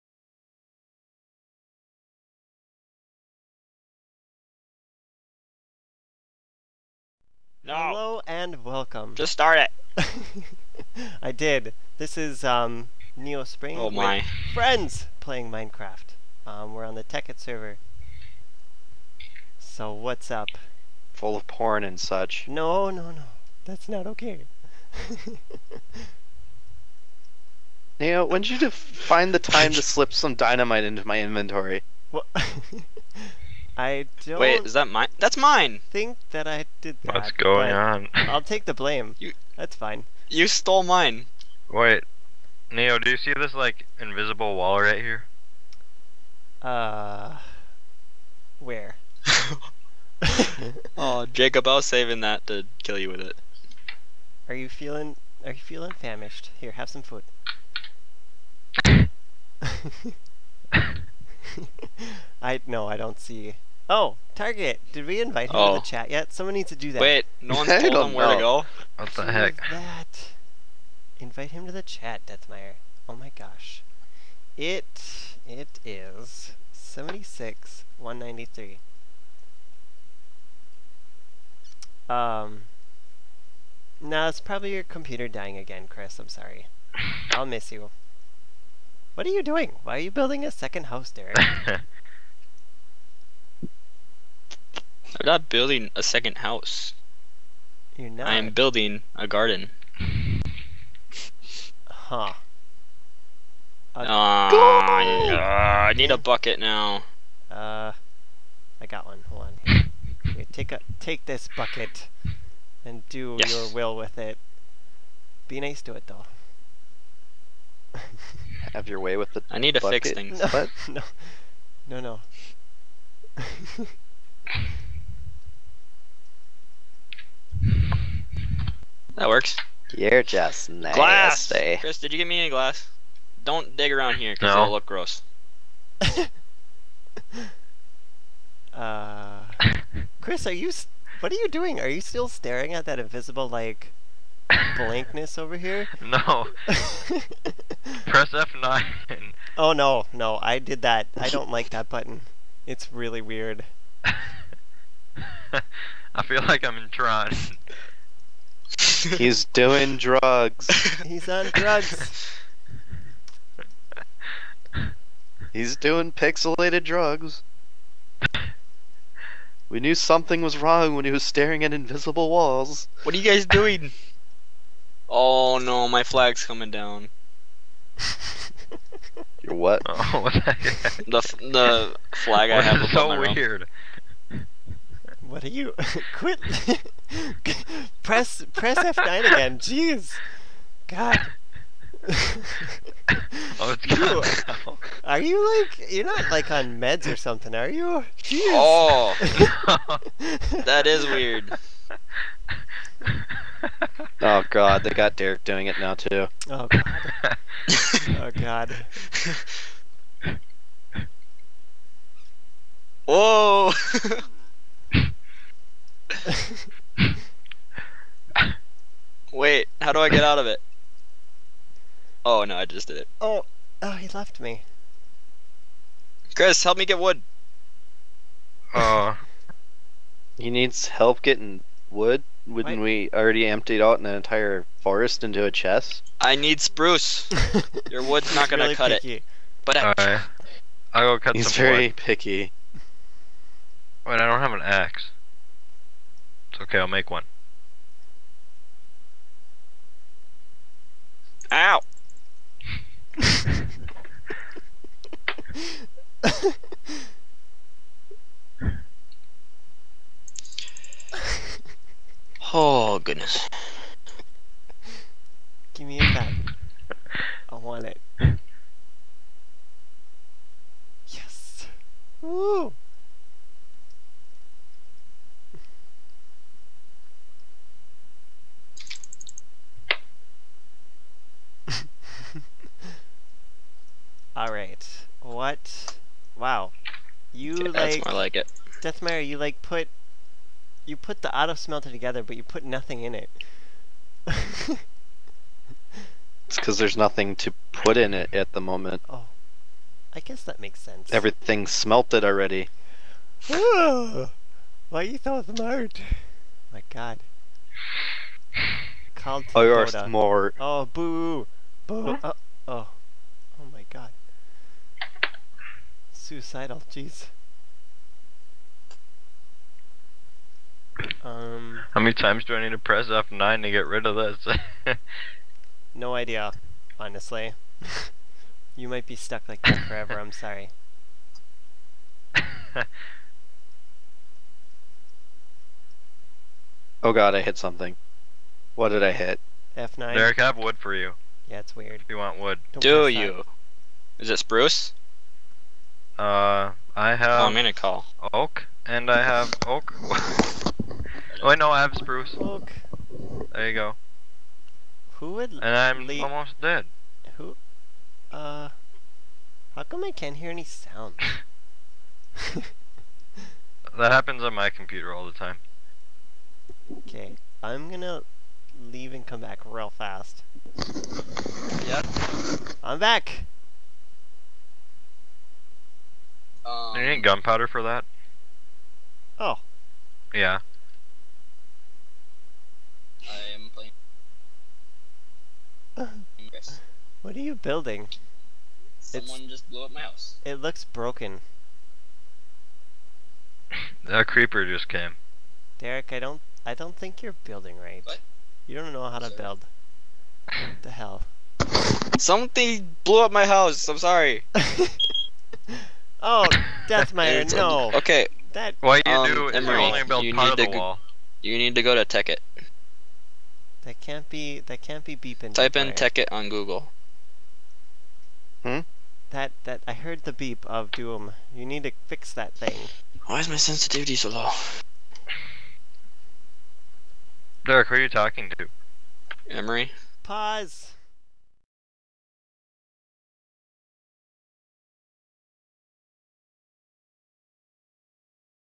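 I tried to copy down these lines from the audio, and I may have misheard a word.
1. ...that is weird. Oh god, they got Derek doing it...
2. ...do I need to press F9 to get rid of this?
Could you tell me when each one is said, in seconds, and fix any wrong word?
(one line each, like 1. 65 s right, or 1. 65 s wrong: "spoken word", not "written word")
1. 200 s right
2. 322 s right.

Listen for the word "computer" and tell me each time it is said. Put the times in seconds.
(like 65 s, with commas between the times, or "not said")
84 s, 364 s.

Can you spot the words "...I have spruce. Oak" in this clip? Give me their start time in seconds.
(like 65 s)
351 s.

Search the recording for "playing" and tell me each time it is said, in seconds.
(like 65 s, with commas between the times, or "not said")
15 s, 383 s.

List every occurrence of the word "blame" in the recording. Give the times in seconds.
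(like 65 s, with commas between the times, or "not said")
38 s.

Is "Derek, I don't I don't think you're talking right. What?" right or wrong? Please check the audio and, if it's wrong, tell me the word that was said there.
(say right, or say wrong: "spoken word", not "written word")
wrong: "building", not "talking".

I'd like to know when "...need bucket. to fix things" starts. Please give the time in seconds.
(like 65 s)
119 s.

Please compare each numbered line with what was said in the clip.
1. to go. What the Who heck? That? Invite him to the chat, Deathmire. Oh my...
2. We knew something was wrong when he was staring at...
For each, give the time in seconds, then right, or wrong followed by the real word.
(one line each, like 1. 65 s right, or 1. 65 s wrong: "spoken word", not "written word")
1. 68 s right
2. 169 s right.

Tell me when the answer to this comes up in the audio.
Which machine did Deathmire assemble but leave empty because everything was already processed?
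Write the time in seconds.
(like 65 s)
291 s.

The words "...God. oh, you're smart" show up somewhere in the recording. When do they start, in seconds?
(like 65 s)
306 s.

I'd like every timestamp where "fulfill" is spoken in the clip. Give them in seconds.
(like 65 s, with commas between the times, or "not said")
not said.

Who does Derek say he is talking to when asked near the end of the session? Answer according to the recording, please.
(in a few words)
Emery.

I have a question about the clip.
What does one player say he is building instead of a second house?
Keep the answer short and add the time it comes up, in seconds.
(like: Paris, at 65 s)
A garden, at 99 s.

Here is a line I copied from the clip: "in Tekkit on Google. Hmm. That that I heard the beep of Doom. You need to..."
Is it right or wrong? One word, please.
right.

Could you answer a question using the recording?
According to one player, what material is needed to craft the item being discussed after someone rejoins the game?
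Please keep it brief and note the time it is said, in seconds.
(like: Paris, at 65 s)
Gunpowder, at 377 s.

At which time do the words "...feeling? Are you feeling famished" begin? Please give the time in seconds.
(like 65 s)
54 s.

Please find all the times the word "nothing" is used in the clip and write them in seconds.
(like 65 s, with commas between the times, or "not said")
292 s, 296 s.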